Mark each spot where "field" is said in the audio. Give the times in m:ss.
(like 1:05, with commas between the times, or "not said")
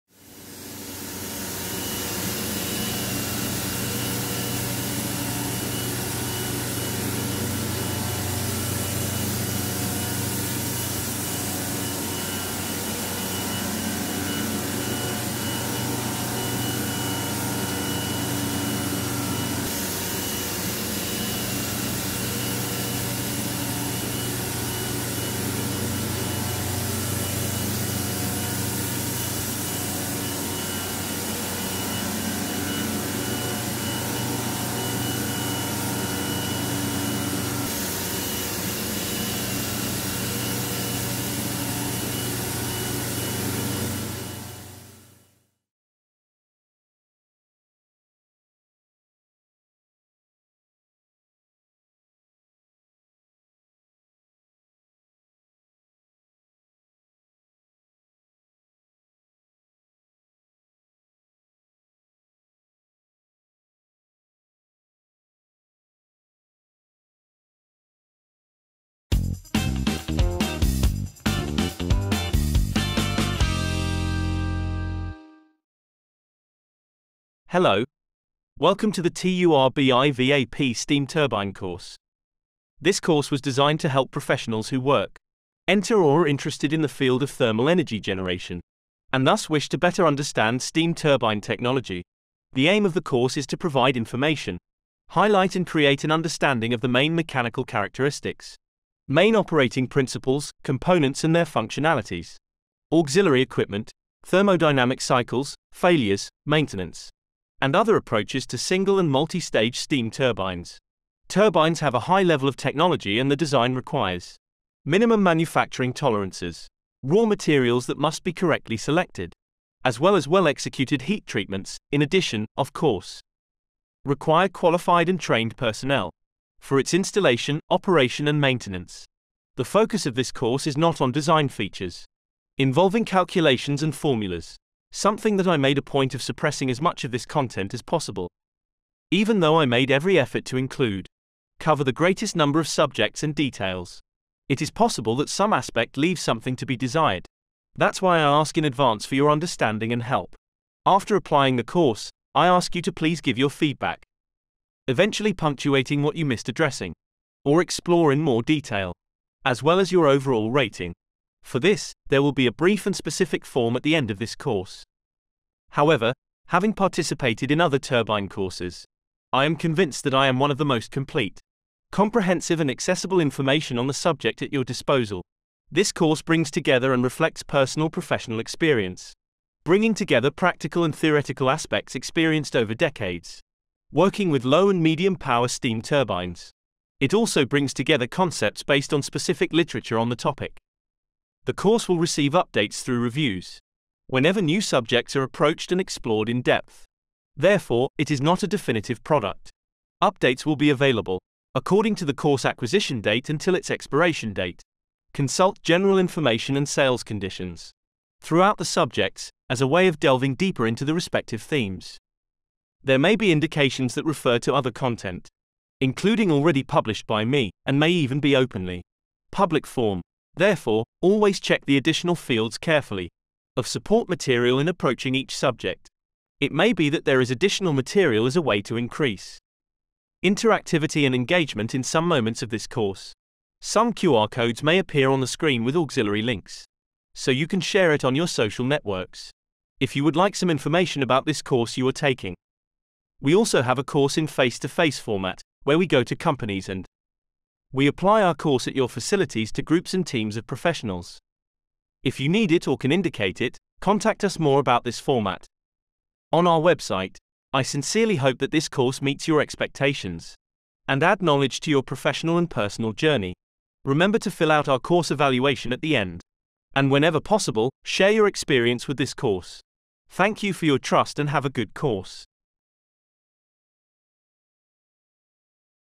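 1:26, 3:42.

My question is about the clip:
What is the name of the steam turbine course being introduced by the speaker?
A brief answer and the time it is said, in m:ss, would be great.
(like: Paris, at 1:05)
TURBIVAP, at 1:19.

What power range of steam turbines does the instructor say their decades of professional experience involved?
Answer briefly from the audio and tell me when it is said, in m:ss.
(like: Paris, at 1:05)
Low and medium power, at 3:04.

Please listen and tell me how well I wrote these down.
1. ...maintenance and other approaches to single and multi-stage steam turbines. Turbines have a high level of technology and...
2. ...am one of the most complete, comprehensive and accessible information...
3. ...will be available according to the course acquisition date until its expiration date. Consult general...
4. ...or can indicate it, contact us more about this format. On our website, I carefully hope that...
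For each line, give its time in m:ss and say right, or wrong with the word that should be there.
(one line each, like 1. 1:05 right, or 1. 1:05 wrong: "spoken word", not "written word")
1. 1:46 right
2. 2:50 right
3. 3:20 right
4. 4:12 wrong: "sincerely", not "carefully".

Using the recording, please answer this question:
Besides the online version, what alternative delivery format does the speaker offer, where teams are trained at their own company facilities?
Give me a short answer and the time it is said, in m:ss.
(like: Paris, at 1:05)
Face to face, at 4:04.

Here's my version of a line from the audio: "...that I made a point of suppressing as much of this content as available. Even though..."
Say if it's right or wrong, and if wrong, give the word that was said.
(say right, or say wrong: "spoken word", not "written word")
wrong: "possible", not "available".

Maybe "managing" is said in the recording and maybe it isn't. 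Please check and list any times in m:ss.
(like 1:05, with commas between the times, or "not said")
not said.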